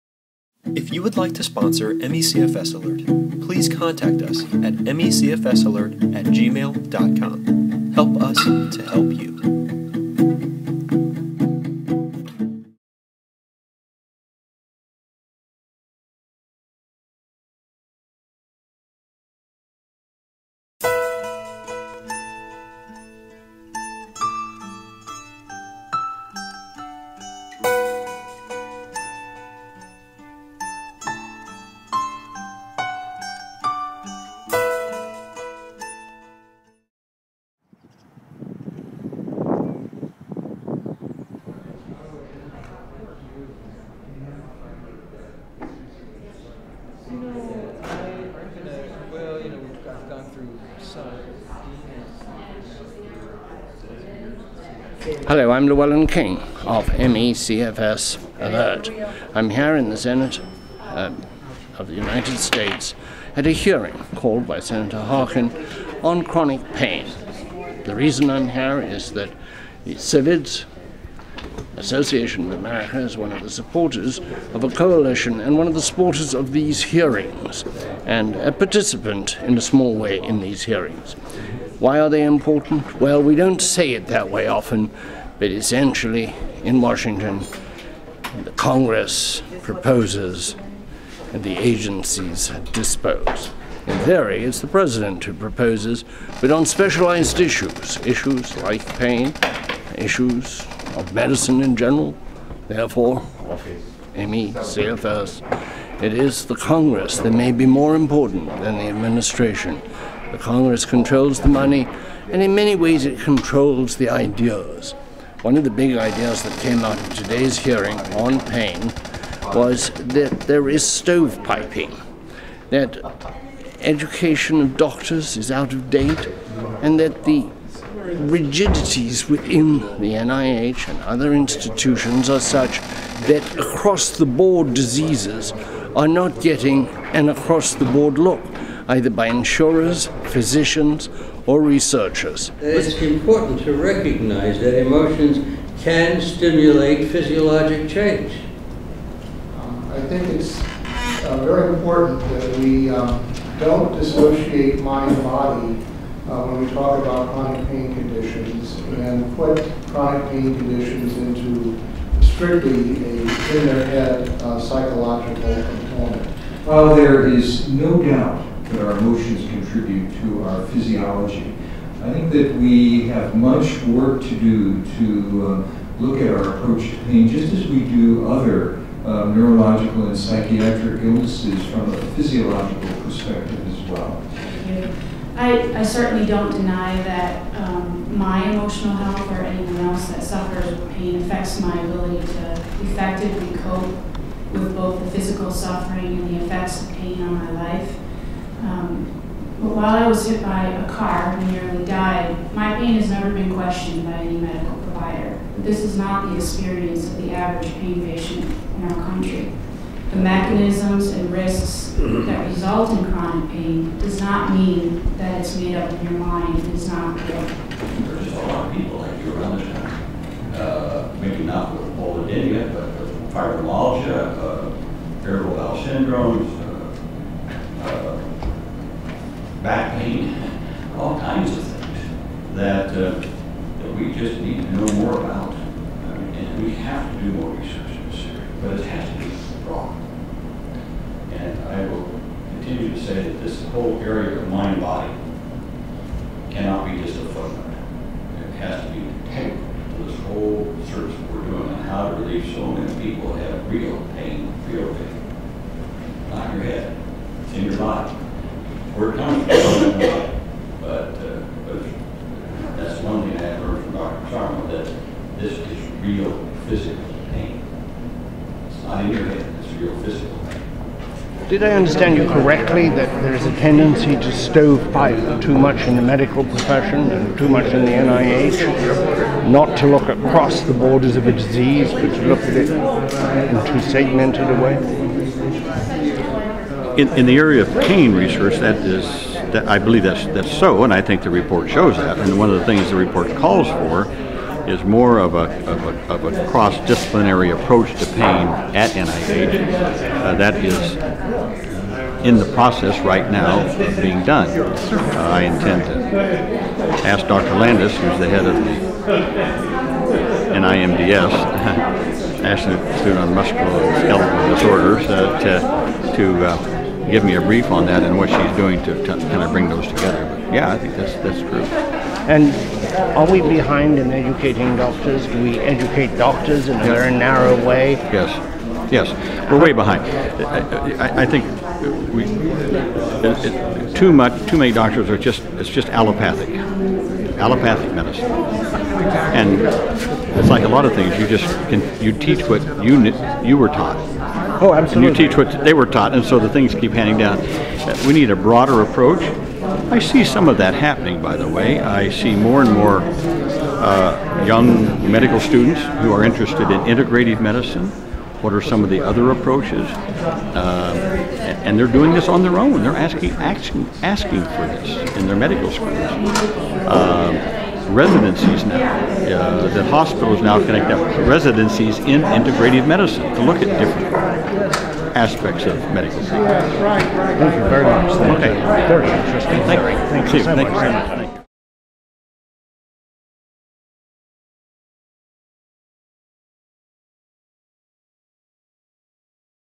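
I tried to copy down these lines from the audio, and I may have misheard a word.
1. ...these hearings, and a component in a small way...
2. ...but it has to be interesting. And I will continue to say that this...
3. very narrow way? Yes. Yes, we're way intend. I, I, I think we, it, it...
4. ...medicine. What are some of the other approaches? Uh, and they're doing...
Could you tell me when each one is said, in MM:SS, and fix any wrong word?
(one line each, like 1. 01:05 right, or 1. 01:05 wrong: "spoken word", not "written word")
1. 01:16 wrong: "participant", not "component"
2. 03:58 wrong: "wrong", not "interesting"
3. 05:26 wrong: "behind", not "intend"
4. 05:57 right.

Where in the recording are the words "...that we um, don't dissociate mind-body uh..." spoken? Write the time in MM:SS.
02:32.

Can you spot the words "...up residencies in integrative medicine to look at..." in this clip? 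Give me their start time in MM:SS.
06:10.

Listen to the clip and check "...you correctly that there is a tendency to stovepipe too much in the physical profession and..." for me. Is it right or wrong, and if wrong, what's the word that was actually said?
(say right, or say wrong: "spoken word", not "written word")
wrong: "medical", not "physical".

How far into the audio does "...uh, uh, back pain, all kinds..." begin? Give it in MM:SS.
03:47.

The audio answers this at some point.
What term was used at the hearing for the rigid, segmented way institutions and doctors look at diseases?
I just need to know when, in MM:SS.
02:00.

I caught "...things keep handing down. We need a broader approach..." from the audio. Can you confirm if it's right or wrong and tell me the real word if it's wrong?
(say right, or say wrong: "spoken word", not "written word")
right.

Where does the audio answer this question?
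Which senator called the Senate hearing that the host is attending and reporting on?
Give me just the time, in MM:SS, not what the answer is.
01:04.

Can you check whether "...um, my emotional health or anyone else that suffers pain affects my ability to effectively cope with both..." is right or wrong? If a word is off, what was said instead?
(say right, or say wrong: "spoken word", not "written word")
right.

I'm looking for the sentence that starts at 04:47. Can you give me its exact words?
In, in the area of pain research, that is, that I believe that's, that's so, and I think the report shows that.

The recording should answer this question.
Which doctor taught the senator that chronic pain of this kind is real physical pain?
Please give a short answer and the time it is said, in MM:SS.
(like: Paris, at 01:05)
Dr. Sharma, at 04:23.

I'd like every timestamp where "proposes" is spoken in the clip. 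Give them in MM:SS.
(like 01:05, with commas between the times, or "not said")
01:29, 01:35.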